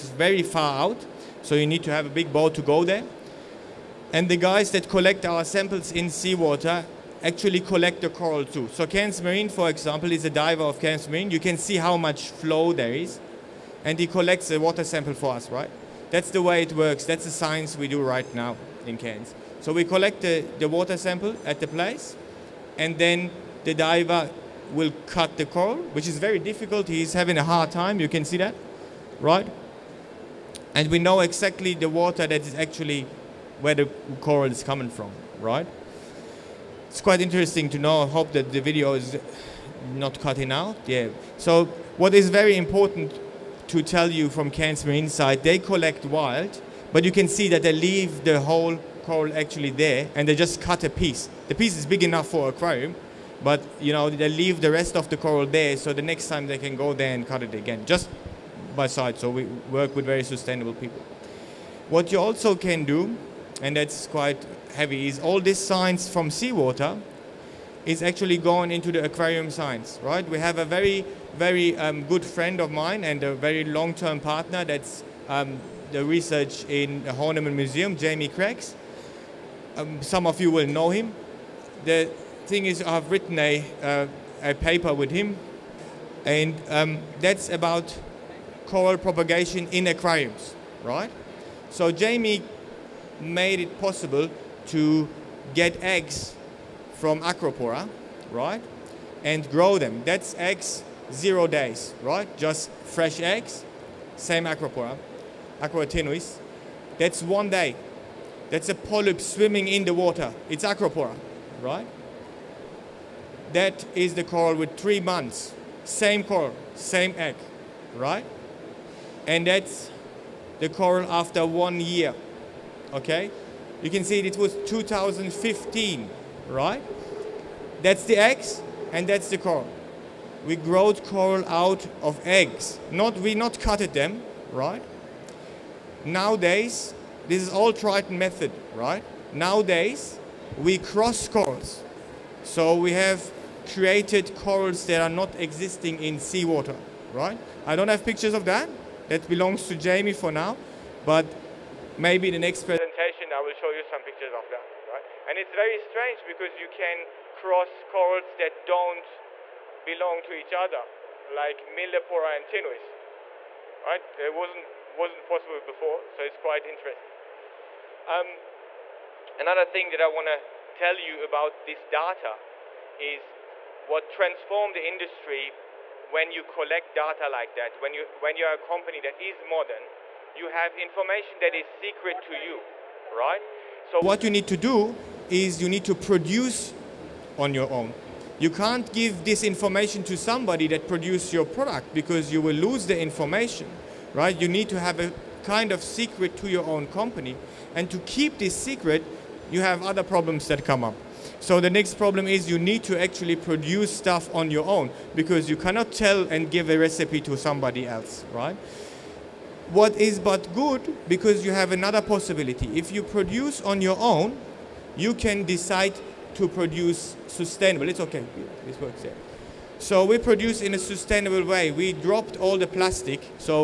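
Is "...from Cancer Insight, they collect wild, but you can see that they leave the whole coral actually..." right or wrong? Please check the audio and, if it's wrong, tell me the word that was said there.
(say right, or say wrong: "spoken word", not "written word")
right.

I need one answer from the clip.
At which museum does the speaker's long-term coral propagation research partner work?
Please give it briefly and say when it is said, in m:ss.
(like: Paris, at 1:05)
Horniman Museum, at 1:17.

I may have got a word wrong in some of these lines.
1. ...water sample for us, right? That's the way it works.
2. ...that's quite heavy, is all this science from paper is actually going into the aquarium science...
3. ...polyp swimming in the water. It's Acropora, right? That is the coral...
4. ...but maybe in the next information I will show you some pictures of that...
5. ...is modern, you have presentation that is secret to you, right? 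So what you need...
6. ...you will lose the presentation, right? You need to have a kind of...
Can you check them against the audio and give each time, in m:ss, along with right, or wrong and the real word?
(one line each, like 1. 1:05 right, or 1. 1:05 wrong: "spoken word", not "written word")
1. 0:14 right
2. 1:03 wrong: "seawater", not "paper"
3. 1:48 right
4. 2:31 wrong: "presentation", not "information"
5. 2:59 wrong: "information", not "presentation"
6. 3:12 wrong: "information", not "presentation".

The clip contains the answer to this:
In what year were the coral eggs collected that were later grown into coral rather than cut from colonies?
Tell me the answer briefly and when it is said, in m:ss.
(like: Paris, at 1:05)
2015, at 2:04.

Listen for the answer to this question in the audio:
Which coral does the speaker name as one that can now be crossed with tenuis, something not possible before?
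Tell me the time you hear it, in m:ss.
2:41.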